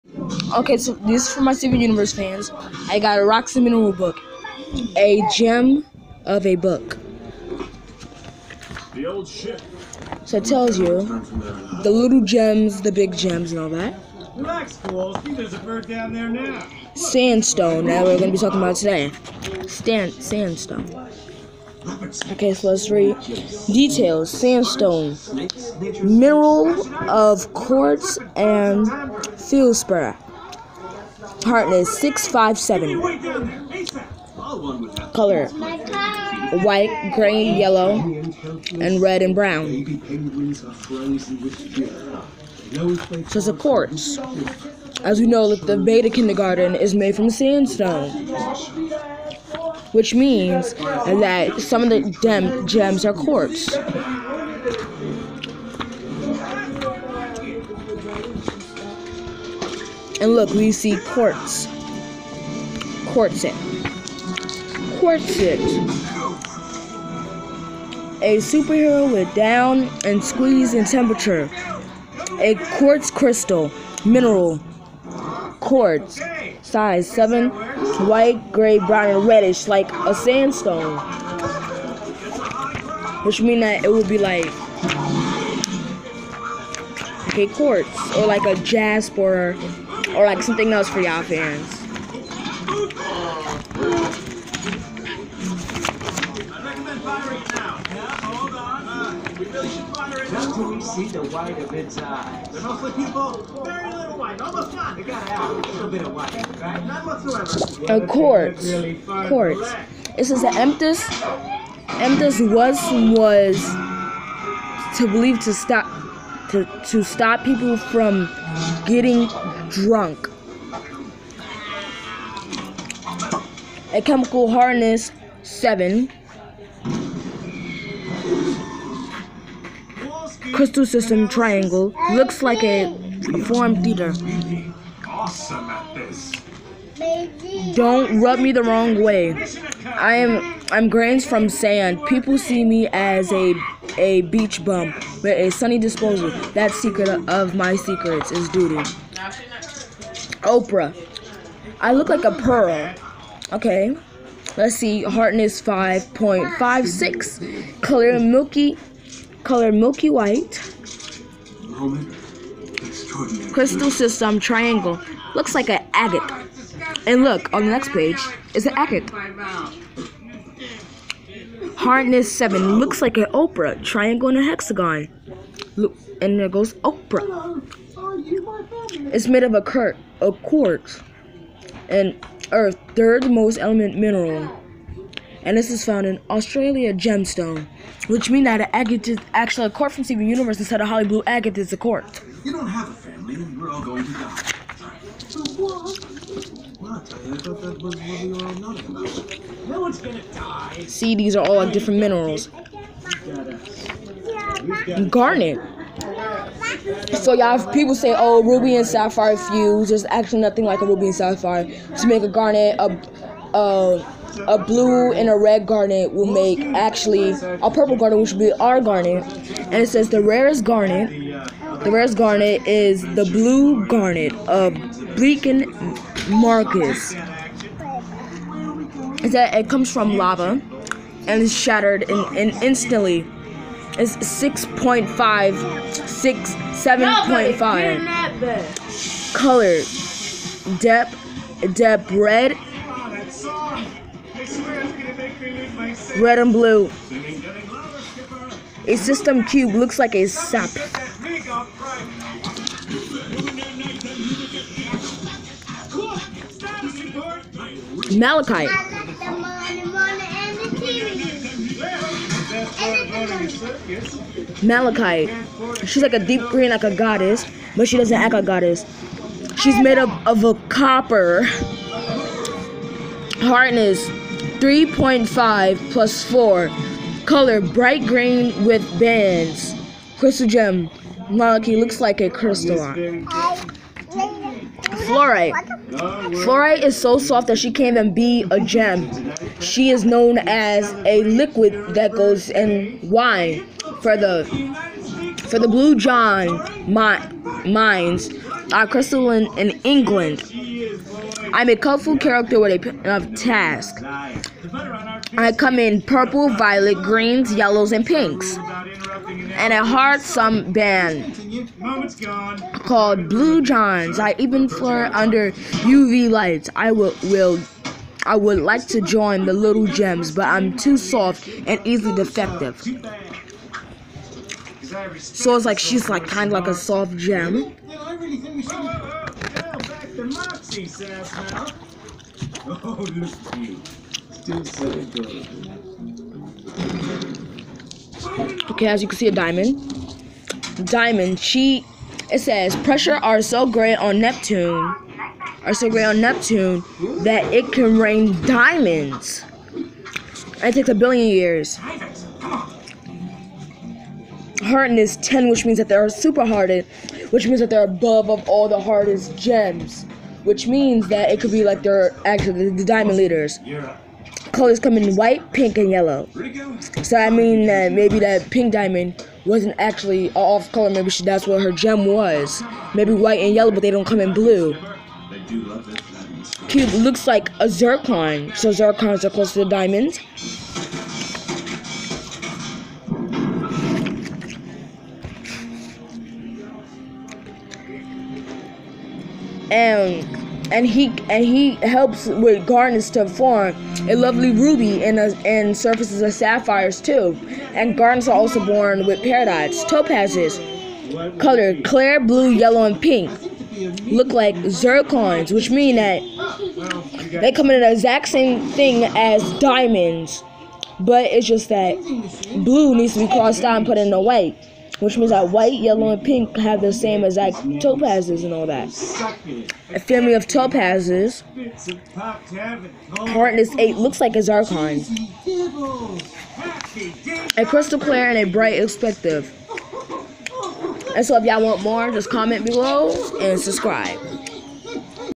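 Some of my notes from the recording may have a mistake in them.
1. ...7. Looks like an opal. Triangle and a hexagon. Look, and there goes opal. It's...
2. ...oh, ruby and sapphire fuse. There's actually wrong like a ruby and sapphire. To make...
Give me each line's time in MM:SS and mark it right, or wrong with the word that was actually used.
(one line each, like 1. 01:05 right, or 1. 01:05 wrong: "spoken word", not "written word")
1. 02:52 right
2. 03:28 wrong: "nothing", not "wrong".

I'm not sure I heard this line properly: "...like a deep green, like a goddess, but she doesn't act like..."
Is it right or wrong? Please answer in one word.
right.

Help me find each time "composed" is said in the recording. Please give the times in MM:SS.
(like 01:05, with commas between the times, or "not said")
not said.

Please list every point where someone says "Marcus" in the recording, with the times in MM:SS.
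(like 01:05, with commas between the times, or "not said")
03:46.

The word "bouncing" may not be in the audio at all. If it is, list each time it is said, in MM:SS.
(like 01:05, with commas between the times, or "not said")
not said.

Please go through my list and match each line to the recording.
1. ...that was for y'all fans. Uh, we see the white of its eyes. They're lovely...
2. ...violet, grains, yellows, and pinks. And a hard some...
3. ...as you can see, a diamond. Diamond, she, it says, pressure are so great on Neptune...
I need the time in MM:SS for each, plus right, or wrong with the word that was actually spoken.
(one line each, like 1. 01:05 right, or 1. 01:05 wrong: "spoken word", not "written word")
1. 01:30 wrong: "mostly", not "lovely"
2. 05:06 wrong: "greens", not "grains"
3. 05:38 right.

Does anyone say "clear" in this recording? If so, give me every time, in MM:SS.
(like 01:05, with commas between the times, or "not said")
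06:41, 07:07.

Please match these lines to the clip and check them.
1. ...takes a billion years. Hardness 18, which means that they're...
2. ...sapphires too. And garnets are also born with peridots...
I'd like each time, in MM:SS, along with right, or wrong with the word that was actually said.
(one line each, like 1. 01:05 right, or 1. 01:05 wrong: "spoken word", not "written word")
1. 05:50 wrong: "10", not "18"
2. 06:36 right.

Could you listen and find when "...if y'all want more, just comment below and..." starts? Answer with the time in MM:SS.
07:11.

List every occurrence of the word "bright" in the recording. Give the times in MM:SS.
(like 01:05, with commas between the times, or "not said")
04:37, 07:08.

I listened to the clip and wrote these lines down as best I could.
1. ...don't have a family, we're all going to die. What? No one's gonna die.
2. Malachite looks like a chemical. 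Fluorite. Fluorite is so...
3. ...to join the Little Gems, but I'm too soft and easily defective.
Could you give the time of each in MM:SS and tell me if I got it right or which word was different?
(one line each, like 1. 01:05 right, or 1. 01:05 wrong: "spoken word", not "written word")
1. 03:12 right
2. 04:41 wrong: "crystal", not "chemical"
3. 05:18 right.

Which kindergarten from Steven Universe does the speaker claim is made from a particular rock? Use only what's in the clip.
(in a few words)
Beta Kindergarten.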